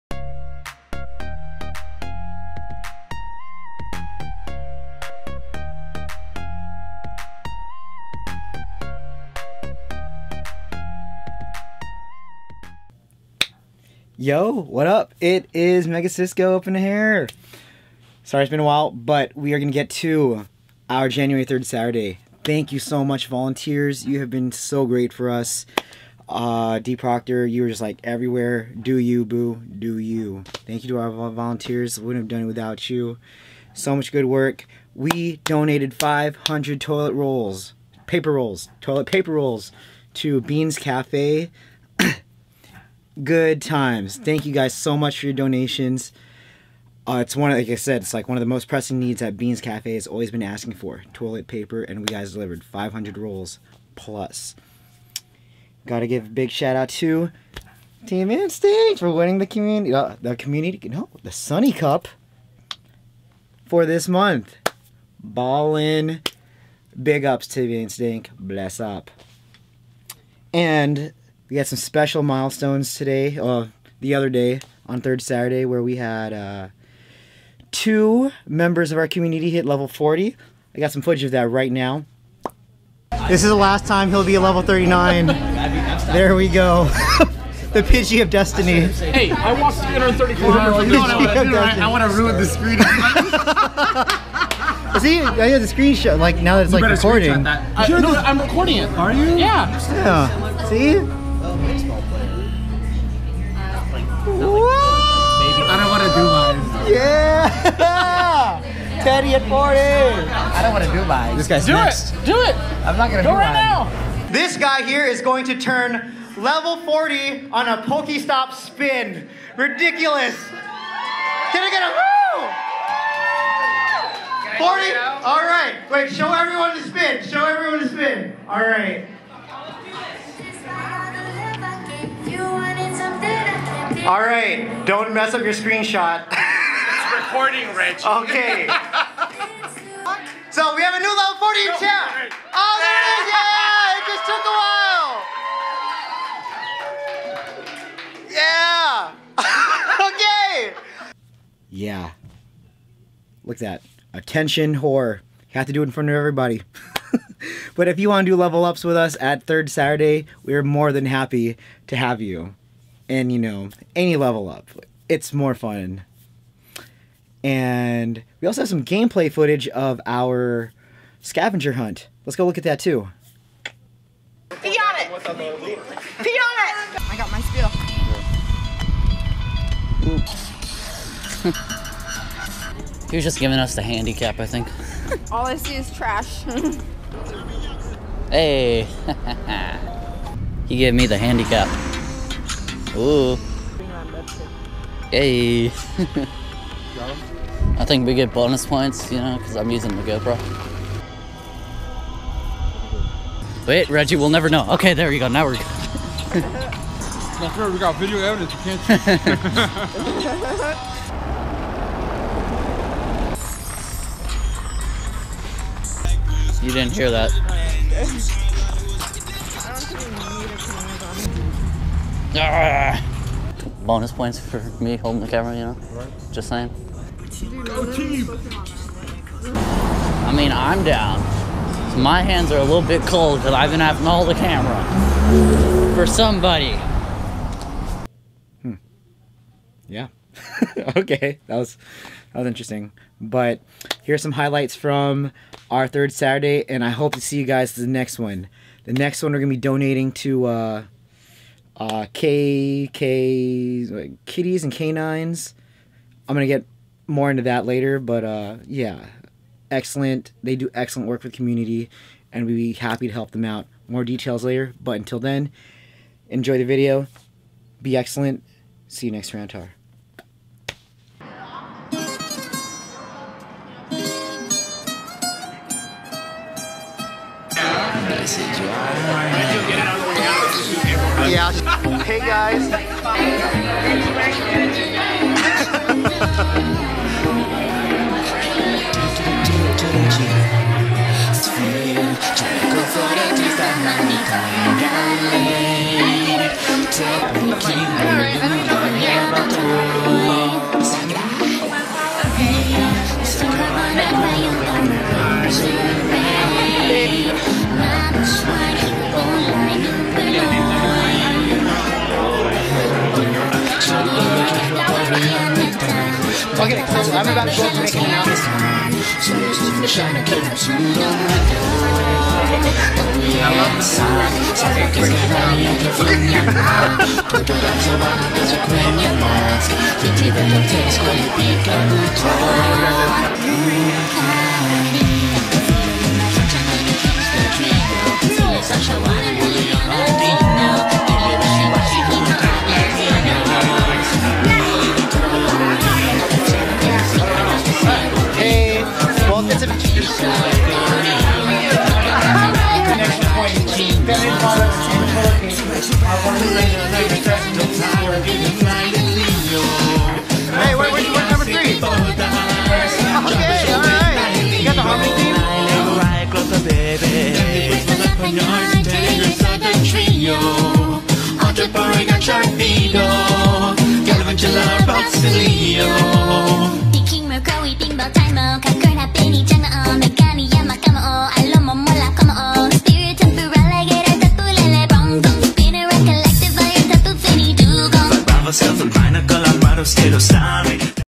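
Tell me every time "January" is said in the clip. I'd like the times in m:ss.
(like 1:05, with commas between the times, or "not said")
0:21.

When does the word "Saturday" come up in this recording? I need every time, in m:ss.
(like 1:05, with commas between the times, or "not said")
0:21, 1:15, 2:39, 4:06.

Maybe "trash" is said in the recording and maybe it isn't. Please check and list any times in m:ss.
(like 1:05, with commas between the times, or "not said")
3:05.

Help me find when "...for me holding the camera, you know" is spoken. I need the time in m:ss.
3:44.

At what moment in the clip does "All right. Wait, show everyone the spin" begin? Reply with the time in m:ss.
2:05.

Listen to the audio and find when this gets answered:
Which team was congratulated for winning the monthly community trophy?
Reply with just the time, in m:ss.
0:58.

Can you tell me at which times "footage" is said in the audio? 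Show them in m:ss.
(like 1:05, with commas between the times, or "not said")
1:21, 2:49.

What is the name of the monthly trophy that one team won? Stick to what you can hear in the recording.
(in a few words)
Sunny Cup.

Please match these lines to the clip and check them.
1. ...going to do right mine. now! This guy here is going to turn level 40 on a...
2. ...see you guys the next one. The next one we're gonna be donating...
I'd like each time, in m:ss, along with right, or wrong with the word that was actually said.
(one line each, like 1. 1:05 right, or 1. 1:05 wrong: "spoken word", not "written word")
1. 1:53 right
2. 4:07 right.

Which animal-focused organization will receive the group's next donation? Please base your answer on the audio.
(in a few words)
Kitties and Canines.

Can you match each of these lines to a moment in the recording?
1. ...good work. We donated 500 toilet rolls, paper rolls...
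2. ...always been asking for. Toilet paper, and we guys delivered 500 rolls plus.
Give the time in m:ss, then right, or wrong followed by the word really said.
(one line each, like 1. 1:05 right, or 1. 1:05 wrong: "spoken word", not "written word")
1. 0:34 right
2. 0:50 right.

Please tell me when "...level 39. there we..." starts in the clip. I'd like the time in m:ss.
1:24.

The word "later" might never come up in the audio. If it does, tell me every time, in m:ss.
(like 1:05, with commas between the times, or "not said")
4:17, 4:24.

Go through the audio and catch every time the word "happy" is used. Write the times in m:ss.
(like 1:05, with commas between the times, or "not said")
2:41, 4:22.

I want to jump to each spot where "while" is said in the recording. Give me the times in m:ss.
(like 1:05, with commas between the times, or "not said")
0:18, 2:28.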